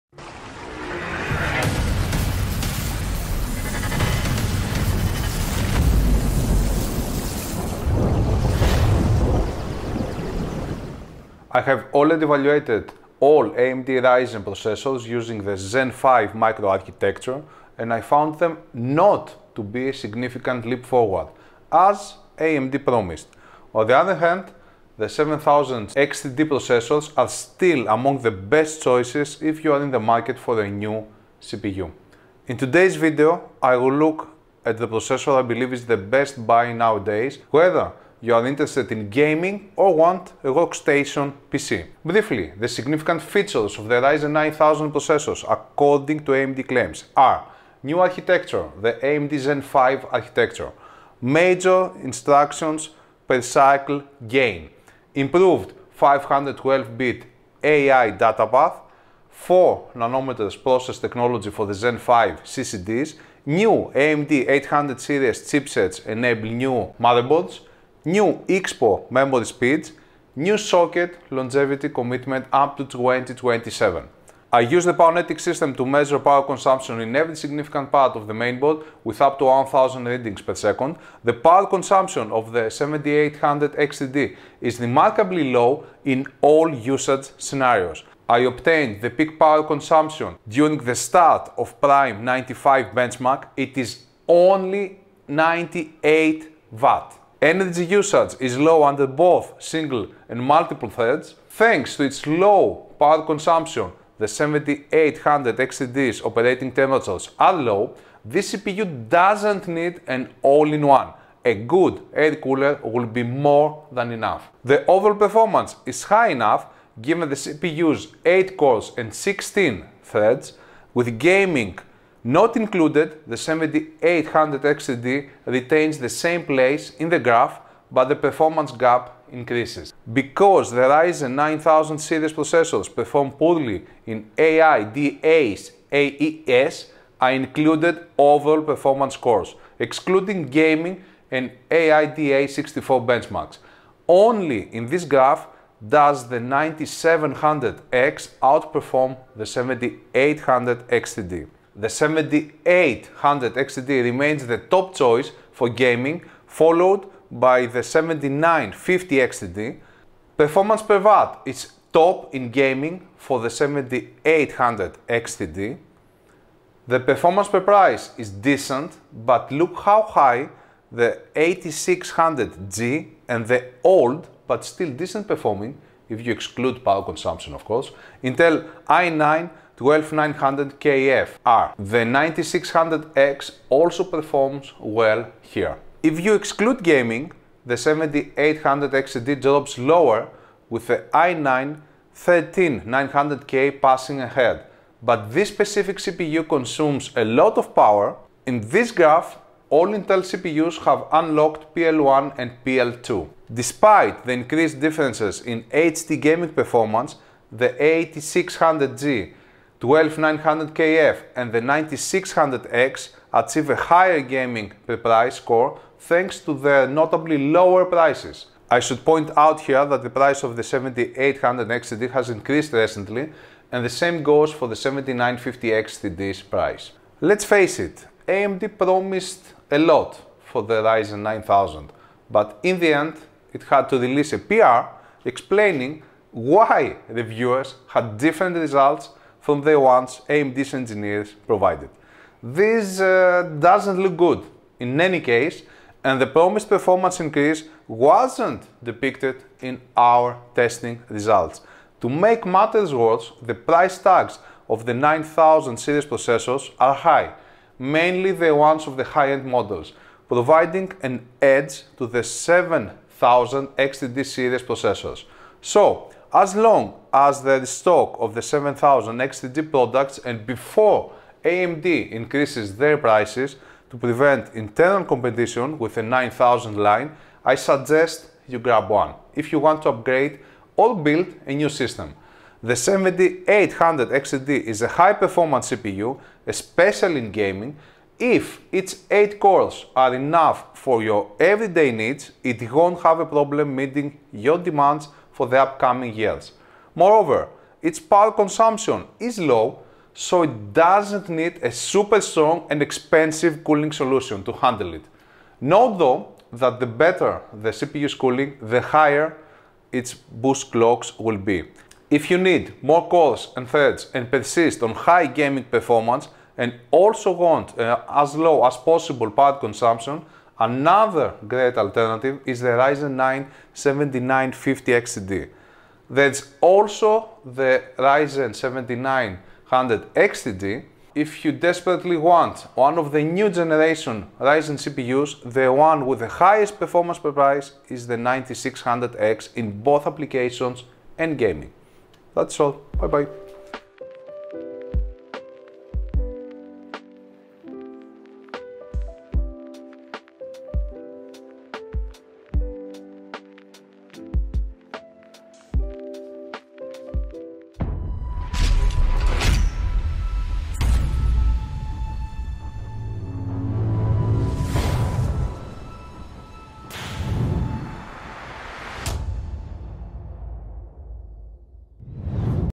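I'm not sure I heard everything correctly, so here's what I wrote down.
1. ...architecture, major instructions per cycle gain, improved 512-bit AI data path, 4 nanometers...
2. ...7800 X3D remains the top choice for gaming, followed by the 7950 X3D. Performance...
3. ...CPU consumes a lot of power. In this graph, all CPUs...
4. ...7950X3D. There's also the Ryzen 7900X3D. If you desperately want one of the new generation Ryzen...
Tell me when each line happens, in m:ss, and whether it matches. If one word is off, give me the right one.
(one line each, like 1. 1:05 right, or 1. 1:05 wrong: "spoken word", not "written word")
1. 0:50 right
2. 2:31 right
3. 3:15 wrong: "Intel", not "CPUs"
4. 5:23 right.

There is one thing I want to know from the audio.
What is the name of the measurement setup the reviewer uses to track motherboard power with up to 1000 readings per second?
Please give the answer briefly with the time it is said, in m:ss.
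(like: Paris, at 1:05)
Powenetics, at 1:14.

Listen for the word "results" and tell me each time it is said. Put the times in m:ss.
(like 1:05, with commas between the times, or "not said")
3:58, 4:11.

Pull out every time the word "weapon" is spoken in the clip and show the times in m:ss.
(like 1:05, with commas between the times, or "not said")
not said.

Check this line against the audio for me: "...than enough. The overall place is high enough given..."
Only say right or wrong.
wrong.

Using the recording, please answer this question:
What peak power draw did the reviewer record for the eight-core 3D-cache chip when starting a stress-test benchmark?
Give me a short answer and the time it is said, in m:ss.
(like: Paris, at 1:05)
98 Watt, at 1:35.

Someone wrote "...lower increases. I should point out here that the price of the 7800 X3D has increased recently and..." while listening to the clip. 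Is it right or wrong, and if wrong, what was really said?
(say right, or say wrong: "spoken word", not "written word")
wrong: "prices", not "increases".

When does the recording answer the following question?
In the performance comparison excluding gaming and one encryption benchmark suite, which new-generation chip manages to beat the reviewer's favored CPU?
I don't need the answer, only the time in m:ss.
2:26.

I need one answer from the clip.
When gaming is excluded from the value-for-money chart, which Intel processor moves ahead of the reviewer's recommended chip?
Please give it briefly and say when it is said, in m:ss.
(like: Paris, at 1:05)
i9 13900K, at 3:11.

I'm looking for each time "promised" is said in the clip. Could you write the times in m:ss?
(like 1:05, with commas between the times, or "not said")
0:22, 3:48, 4:06.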